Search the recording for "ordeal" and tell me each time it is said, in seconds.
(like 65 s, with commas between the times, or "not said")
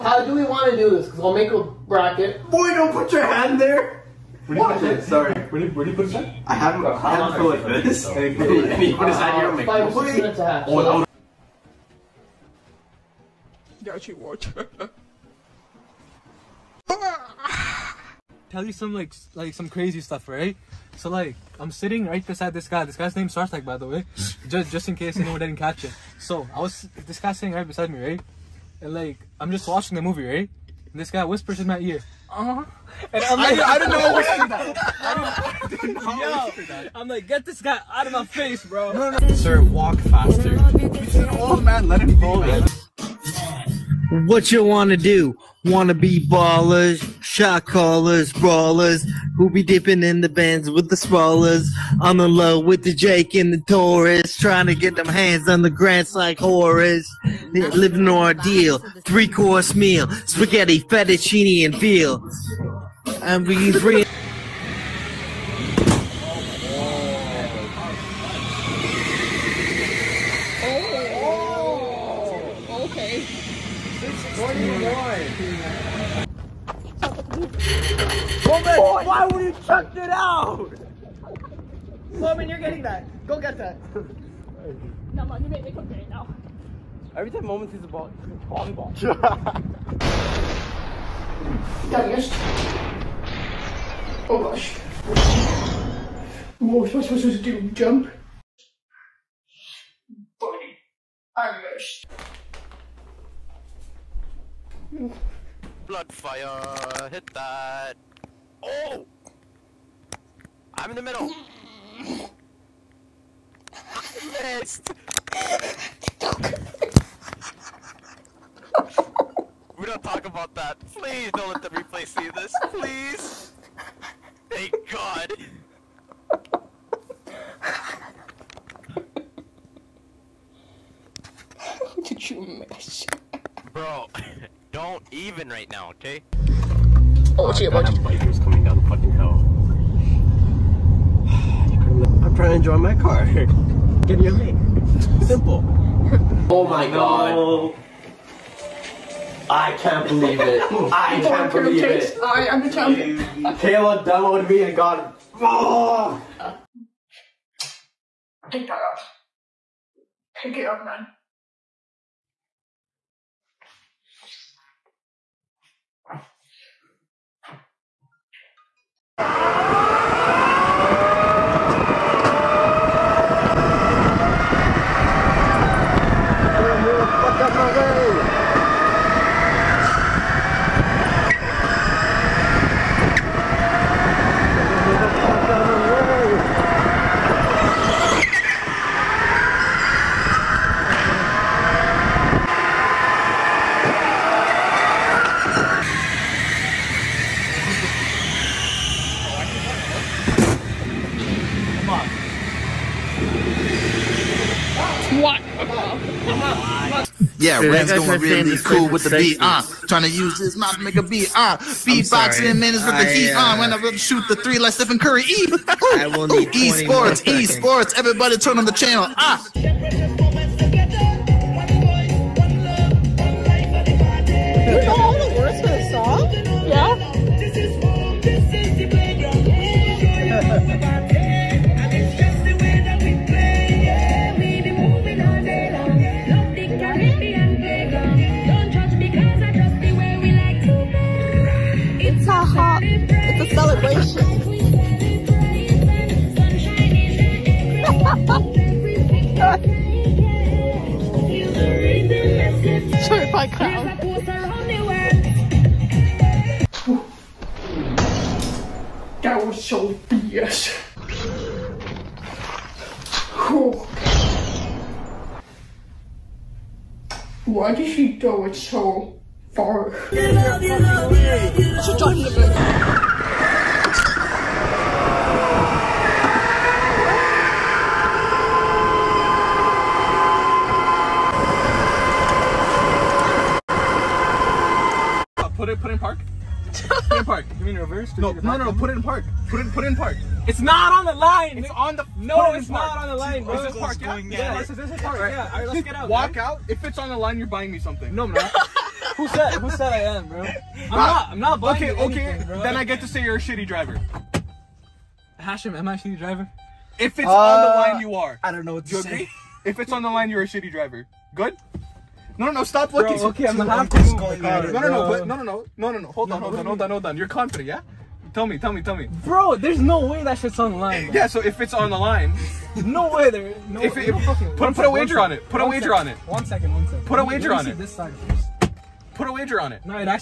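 58 s.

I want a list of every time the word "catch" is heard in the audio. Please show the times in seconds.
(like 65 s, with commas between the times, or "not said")
25 s.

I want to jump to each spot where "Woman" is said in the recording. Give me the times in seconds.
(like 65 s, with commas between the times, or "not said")
74 s, 82 s.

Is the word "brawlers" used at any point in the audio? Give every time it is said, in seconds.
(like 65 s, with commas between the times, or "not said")
48 s.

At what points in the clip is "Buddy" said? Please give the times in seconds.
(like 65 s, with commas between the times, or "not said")
100 s.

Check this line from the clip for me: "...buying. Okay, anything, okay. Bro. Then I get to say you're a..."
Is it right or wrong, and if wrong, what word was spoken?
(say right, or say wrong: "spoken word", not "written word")
right.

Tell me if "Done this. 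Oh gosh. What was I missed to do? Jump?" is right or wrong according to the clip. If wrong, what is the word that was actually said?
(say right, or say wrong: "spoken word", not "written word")
wrong: "supposed", not "missed".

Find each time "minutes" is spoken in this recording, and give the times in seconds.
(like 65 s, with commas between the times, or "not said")
9 s, 212 s.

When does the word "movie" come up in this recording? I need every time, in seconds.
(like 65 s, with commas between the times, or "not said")
30 s.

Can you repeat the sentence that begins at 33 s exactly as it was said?
And I'm like, I, I didn't know what to that.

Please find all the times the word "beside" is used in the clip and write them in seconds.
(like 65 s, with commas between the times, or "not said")
22 s, 27 s.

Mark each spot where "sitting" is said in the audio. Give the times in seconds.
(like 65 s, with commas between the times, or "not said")
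21 s, 27 s.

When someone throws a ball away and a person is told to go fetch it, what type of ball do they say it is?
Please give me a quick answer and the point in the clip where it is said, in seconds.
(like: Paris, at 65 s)
volleyball, at 88 s.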